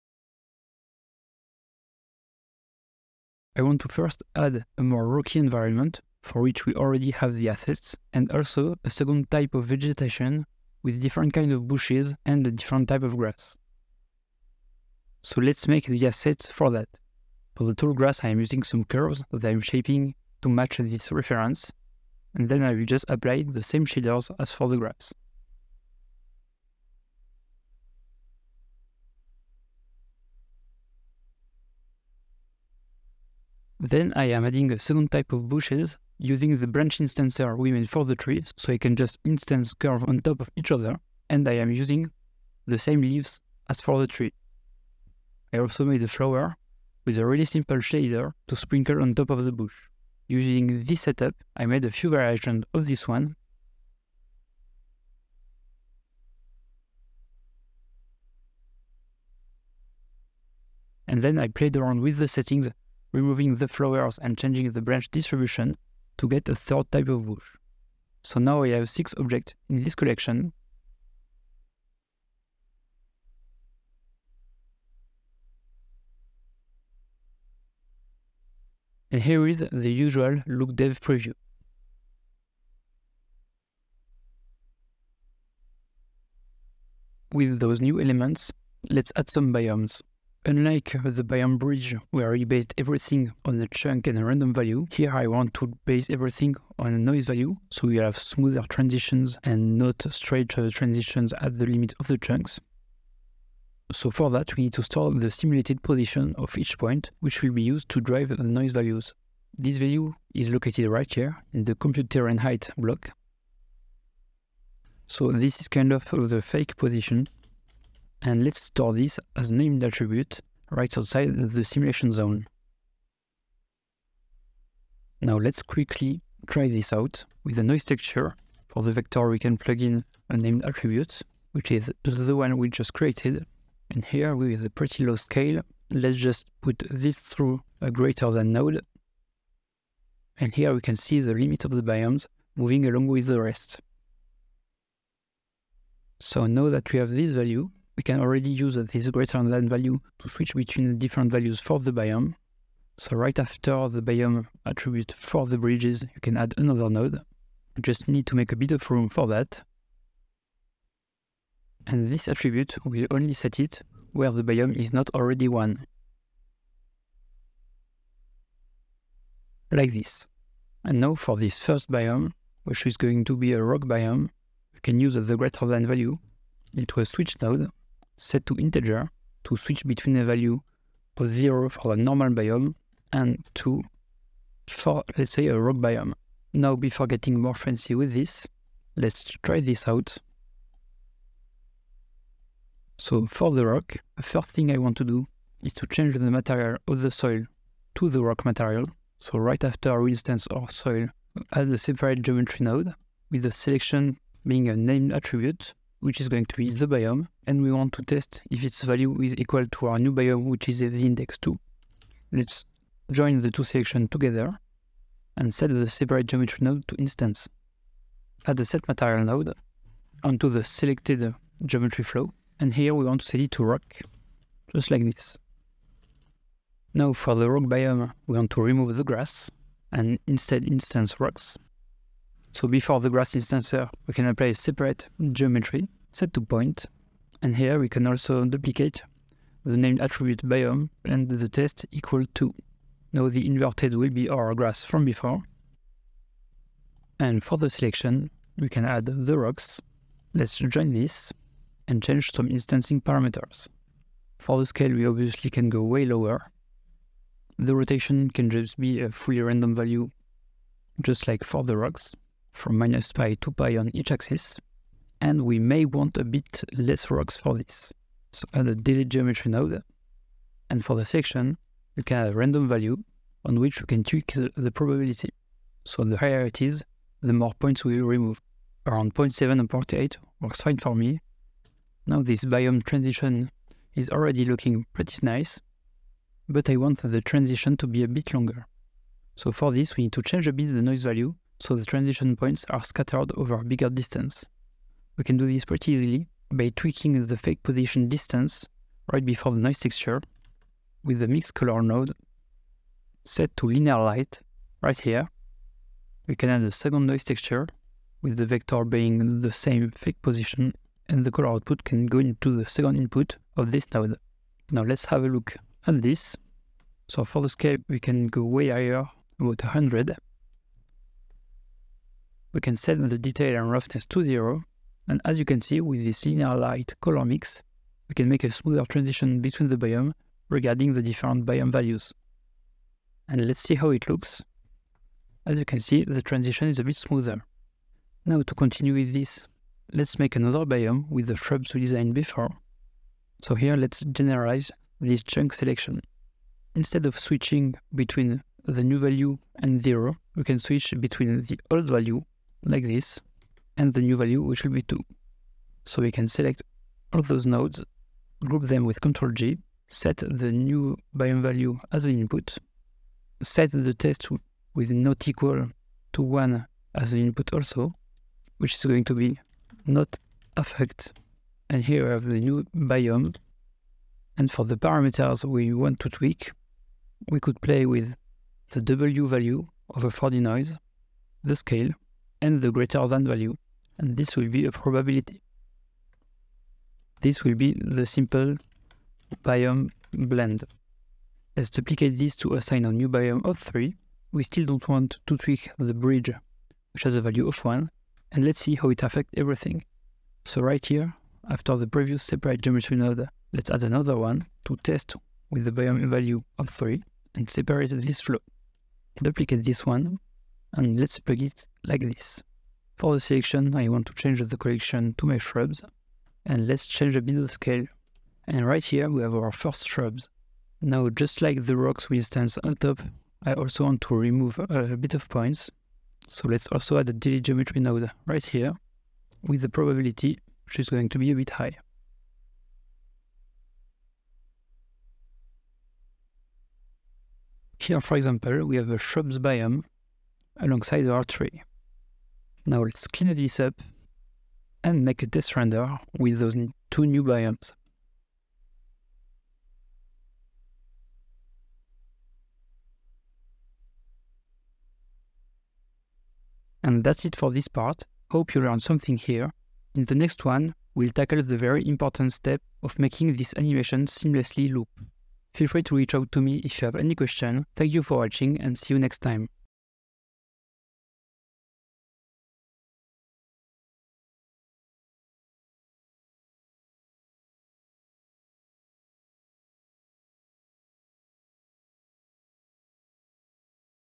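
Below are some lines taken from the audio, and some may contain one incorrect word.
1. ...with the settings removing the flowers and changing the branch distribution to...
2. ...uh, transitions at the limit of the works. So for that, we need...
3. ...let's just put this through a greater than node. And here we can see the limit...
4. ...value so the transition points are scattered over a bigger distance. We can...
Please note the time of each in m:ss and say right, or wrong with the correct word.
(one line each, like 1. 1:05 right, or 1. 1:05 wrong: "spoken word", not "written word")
1. 1:02 right
2. 1:40 wrong: "chunks", not "works"
3. 2:15 right
4. 4:51 right.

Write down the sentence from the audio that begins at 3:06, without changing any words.
Now, before getting more fancy with this, let's try this out.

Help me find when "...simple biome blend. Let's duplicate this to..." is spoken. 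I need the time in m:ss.
6:28.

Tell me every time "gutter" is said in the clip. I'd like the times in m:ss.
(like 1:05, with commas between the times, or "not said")
not said.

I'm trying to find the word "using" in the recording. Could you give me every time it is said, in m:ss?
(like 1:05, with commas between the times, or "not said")
0:18, 0:36, 0:41, 0:50.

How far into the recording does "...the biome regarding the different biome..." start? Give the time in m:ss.
5:29.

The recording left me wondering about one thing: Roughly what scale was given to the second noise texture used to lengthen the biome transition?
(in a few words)
100.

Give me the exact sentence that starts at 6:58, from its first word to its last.
And right here, we have our first shrubs.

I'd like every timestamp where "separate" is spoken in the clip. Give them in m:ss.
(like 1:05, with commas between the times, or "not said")
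3:21, 3:35, 3:54, 6:42, 6:47.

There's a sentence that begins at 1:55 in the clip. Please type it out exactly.
So this is kind of the fake position and let's store this as named attribute right outside the simulation zone.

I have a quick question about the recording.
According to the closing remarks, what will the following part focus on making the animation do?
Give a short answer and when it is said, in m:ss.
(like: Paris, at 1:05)
Seamlessly loop, at 7:44.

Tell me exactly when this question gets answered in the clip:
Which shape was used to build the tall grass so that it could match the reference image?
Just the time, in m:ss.
0:18.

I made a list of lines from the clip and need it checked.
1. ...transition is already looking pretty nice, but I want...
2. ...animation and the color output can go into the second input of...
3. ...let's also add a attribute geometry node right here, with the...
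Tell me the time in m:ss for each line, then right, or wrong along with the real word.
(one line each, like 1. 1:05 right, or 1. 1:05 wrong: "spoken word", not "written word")
1. 4:42 right
2. 5:10 wrong: "position", not "animation"
3. 7:06 wrong: "delete", not "attribute".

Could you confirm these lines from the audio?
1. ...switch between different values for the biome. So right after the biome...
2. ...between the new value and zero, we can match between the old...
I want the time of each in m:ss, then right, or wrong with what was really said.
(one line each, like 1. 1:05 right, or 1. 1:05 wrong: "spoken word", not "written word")
1. 2:30 right
2. 5:47 wrong: "switch", not "match".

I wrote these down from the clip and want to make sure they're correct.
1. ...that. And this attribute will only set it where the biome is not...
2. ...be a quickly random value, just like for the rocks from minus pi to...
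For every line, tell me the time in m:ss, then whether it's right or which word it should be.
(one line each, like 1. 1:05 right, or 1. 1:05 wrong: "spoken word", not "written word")
1. 2:39 right
2. 4:18 wrong: "fully", not "quickly".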